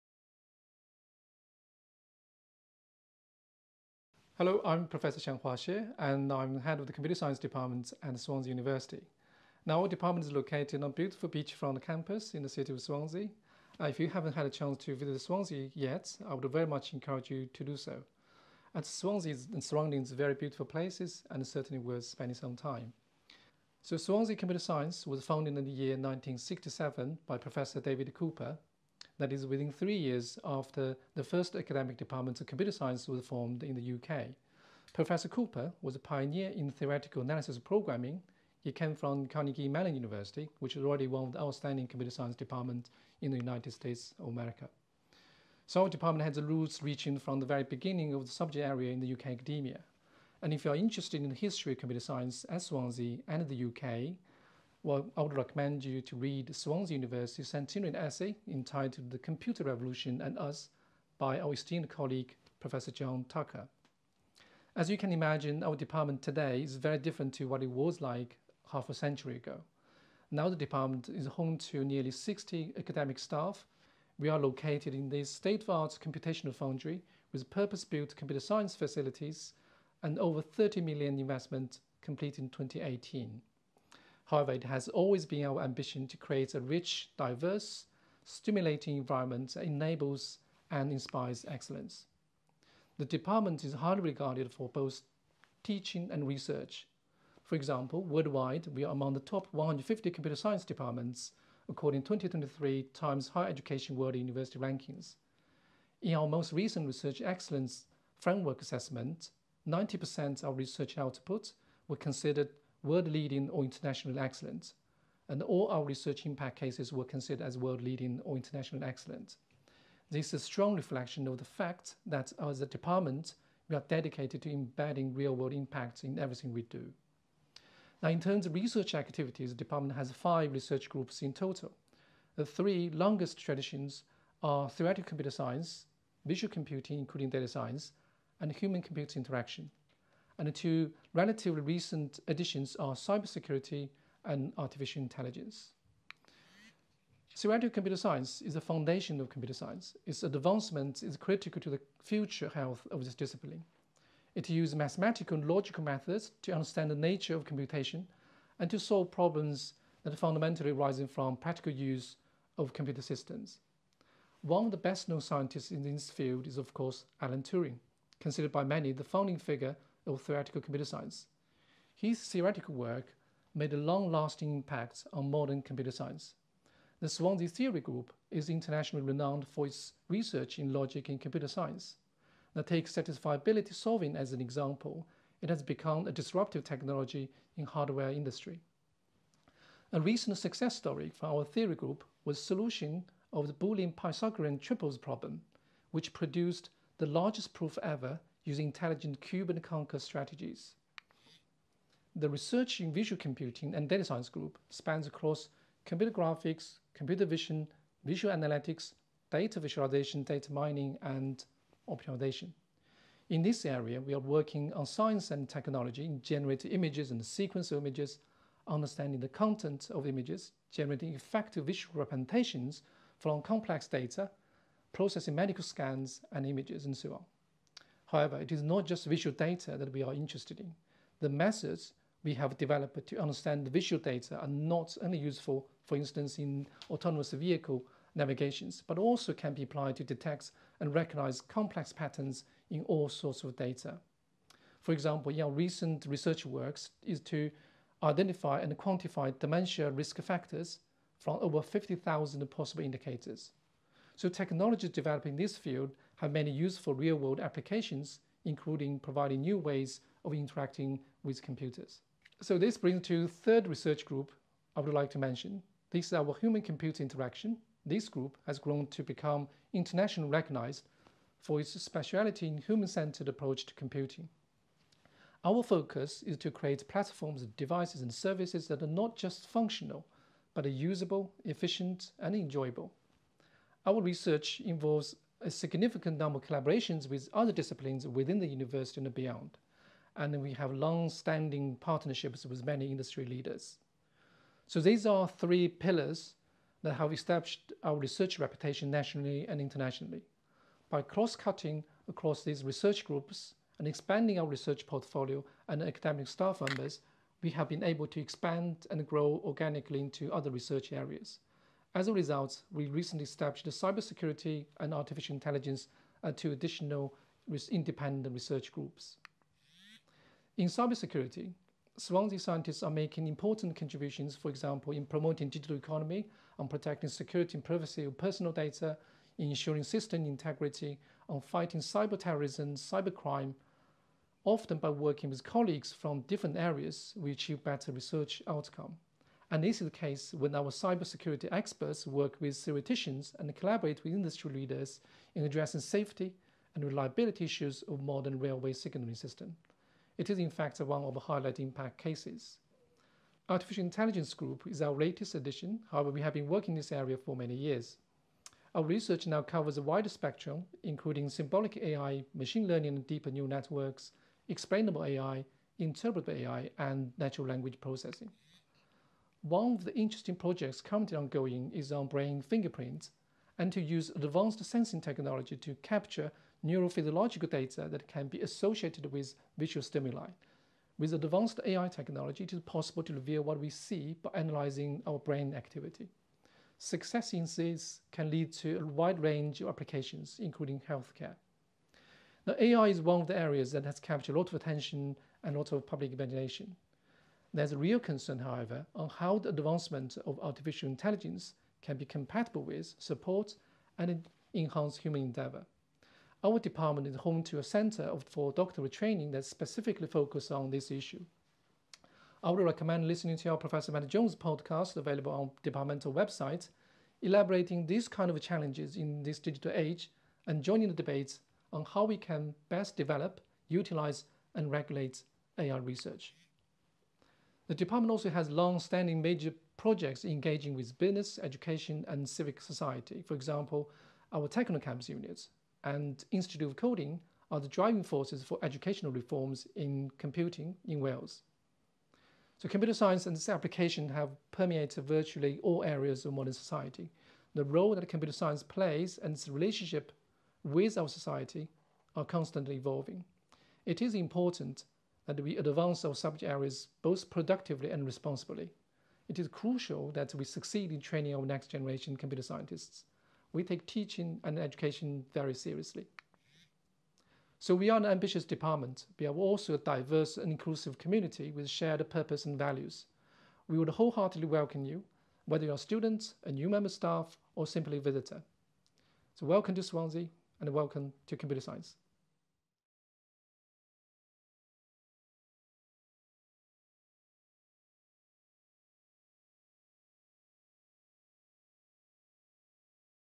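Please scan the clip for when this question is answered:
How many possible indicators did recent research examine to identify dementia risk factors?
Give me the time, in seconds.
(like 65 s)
251 s.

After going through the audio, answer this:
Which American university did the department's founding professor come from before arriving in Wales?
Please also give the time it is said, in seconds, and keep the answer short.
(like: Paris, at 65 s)
Carnegie Mellon University, at 39 s.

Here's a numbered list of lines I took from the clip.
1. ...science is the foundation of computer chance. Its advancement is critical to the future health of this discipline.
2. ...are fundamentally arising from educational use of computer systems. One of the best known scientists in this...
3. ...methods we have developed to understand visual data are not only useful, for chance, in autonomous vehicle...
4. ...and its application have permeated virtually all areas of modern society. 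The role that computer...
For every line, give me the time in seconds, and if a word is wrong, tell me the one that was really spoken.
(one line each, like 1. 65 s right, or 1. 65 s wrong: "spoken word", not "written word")
1. 147 s wrong: "science", not "chance"
2. 160 s wrong: "practical", not "educational"
3. 231 s wrong: "instance", not "chance"
4. 443 s right.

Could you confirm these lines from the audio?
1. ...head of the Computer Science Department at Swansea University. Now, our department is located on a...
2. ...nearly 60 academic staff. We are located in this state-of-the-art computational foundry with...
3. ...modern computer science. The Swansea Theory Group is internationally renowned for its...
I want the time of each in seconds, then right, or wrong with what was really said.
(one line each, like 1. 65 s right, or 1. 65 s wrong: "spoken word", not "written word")
1. 6 s right
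2. 71 s right
3. 175 s right.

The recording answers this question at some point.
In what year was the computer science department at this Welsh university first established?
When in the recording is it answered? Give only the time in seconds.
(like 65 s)
25 s.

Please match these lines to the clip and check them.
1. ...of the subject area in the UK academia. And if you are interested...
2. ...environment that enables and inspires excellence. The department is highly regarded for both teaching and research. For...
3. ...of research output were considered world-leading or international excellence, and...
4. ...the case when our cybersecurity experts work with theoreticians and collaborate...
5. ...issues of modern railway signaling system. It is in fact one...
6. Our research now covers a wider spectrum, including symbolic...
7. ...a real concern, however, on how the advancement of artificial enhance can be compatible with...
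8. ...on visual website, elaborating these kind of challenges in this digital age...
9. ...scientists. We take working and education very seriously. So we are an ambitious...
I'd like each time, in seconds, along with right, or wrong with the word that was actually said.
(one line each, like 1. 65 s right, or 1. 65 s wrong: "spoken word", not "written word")
1. 48 s right
2. 88 s right
3. 110 s right
4. 339 s right
5. 347 s right
6. 358 s right
7. 397 s wrong: "intelligence", not "enhance"
8. 415 s wrong: "departmental", not "visual"
9. 462 s wrong: "teaching", not "working".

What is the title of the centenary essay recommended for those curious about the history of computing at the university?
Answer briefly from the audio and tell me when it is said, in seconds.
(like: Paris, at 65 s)
The Computer Revolution and Us, at 59 s.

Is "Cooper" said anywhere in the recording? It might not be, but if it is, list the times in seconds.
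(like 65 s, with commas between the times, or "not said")
28 s, 35 s.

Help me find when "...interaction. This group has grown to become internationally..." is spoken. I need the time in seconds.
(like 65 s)
267 s.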